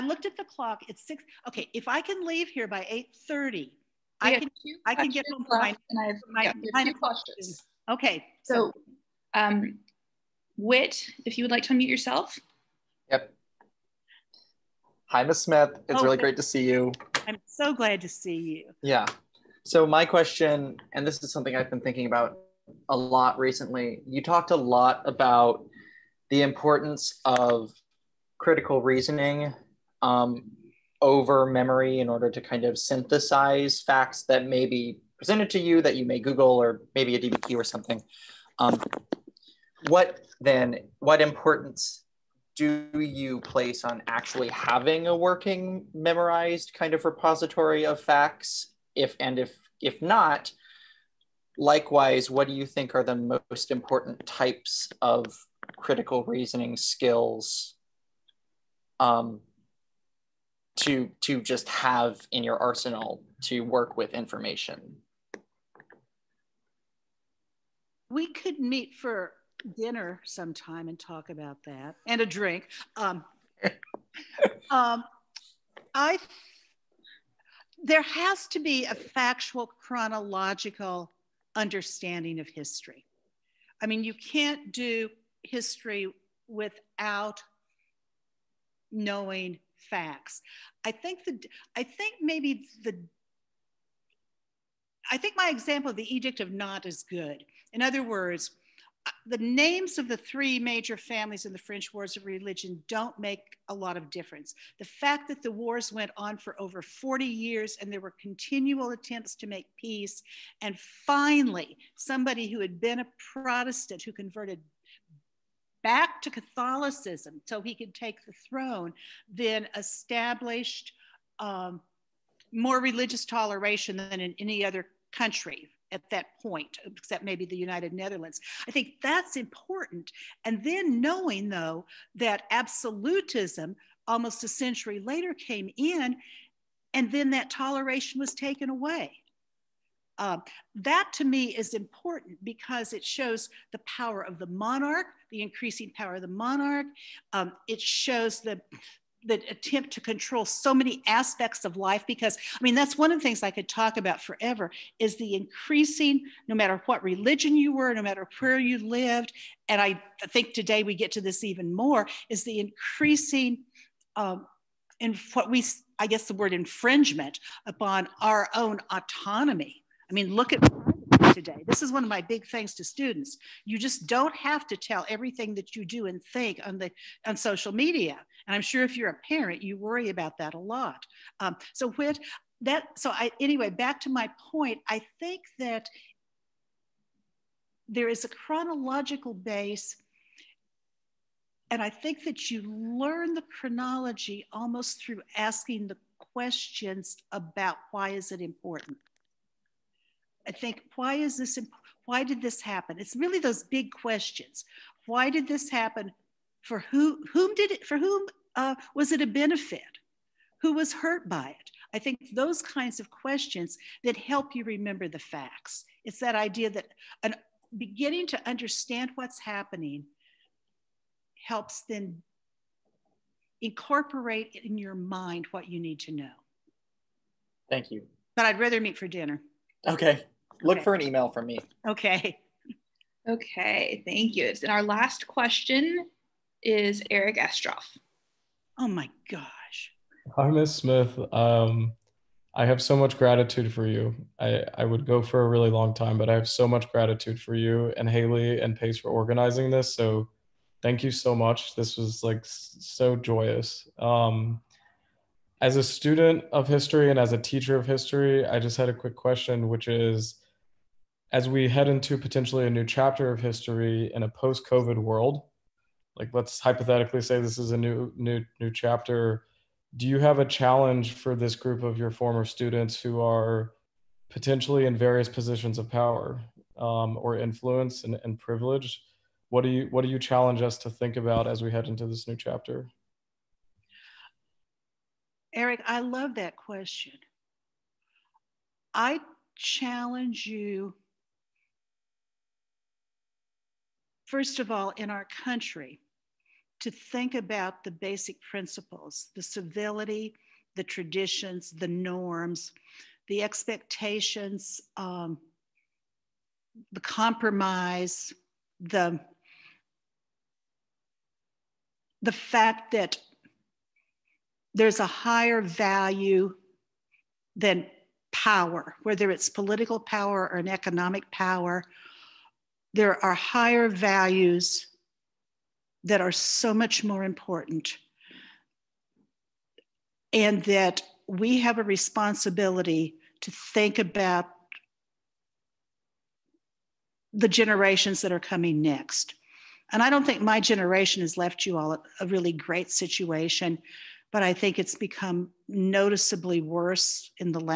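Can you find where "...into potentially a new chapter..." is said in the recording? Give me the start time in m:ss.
4:21.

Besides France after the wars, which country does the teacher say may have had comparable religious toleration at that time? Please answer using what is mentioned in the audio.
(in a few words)
United Netherlands.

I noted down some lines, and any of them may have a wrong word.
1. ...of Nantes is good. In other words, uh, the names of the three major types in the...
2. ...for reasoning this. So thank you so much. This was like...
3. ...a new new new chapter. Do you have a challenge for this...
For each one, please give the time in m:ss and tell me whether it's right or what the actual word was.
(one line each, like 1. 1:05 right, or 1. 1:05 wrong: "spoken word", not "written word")
1. 1:36 wrong: "families", not "types"
2. 4:08 wrong: "organizing", not "reasoning"
3. 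4:27 right.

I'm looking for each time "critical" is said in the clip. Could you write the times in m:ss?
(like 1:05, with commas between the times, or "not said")
0:28, 0:55.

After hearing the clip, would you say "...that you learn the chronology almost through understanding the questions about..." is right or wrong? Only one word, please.
wrong.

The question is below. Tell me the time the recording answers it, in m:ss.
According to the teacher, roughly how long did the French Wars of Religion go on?
1:46.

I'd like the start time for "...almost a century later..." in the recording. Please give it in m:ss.
2:14.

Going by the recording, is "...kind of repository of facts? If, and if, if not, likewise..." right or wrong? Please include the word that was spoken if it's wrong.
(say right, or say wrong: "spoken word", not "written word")
right.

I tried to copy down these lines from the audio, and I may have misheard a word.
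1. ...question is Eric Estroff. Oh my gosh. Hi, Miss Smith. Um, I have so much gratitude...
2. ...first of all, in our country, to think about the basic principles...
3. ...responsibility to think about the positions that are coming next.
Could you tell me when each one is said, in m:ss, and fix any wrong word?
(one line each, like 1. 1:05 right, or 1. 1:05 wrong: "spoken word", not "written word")
1. 3:55 right
2. 4:54 right
3. 5:31 wrong: "generations", not "positions".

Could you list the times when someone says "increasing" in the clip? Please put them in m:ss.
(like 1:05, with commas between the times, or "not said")
2:25, 2:35, 2:42.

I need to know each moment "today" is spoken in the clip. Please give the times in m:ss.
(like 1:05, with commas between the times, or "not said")
2:40, 2:51.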